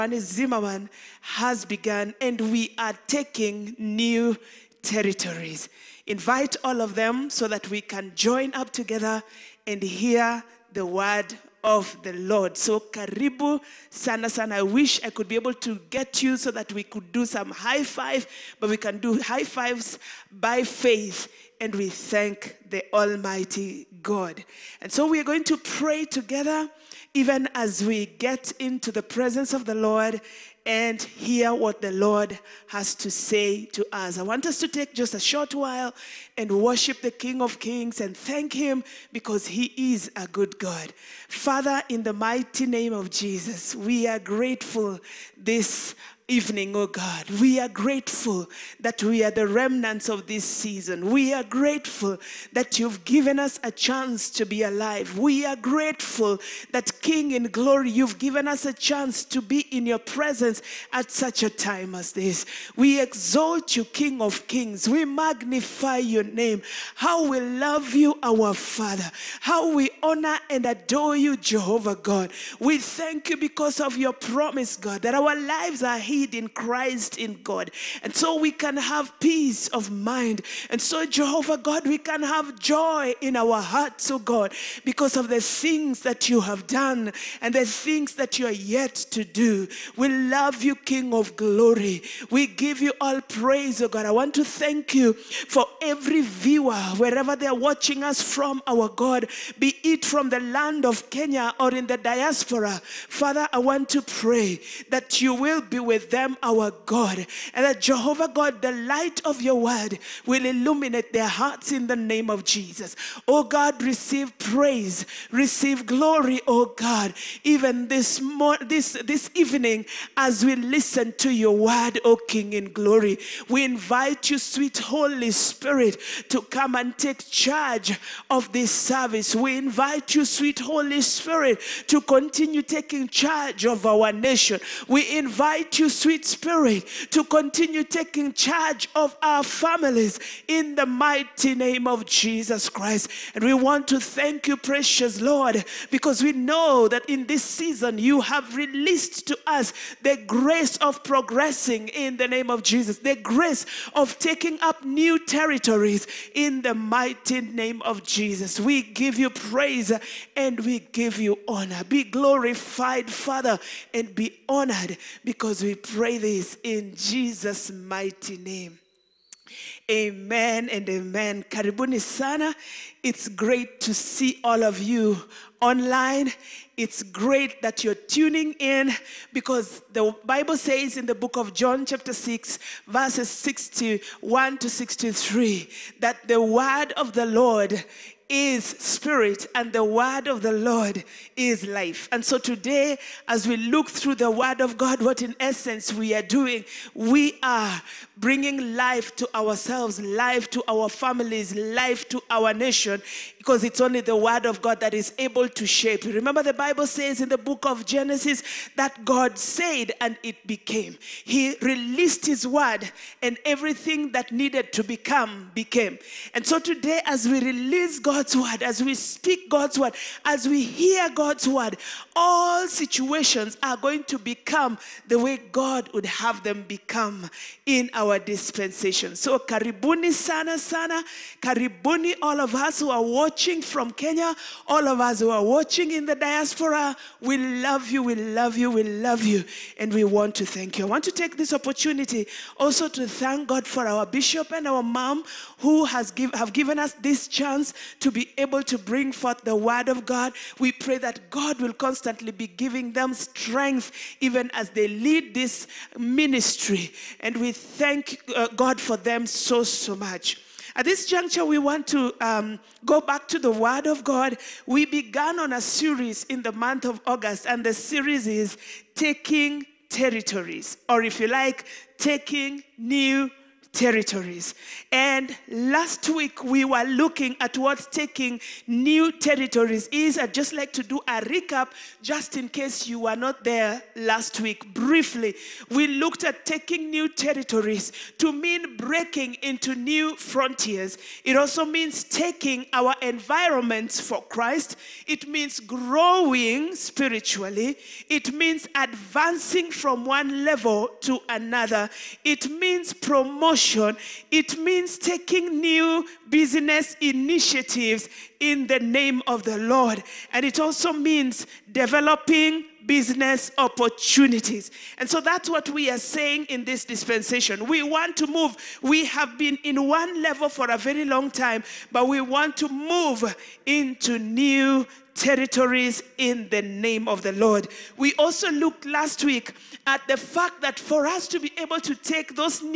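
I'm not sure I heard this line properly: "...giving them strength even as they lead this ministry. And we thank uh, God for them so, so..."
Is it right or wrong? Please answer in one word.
right.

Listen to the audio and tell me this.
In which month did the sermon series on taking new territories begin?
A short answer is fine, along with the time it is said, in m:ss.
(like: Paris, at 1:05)
August, at 4:27.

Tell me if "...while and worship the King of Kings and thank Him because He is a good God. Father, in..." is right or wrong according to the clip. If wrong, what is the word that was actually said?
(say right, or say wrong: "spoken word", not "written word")
right.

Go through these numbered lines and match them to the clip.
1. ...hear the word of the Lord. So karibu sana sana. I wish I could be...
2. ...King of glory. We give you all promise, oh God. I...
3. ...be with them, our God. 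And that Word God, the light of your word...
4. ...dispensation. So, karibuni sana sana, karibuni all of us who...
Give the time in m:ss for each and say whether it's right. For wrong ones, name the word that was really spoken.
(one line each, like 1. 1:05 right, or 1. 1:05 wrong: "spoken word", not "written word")
1. 0:09 right
2. 1:30 wrong: "praise", not "promise"
3. 1:45 wrong: "Jehovah", not "Word"
4. 3:48 right.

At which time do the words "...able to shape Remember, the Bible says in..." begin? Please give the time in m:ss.
3:25.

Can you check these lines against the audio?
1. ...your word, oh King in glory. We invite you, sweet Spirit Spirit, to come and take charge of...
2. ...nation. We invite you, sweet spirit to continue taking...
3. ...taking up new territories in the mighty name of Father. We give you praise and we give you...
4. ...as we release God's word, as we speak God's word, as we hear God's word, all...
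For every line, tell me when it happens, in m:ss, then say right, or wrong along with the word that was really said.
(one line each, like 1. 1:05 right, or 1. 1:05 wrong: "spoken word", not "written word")
1. 2:01 wrong: "Holy", not "Spirit"
2. 2:14 right
3. 2:34 wrong: "Jesus", not "Father"
4. 3:37 right.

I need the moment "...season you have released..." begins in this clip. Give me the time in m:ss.
2:27.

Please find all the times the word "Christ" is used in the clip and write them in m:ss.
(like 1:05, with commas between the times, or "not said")
1:16, 2:22, 4:54.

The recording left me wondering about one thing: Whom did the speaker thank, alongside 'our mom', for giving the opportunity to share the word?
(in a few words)
Our bishop.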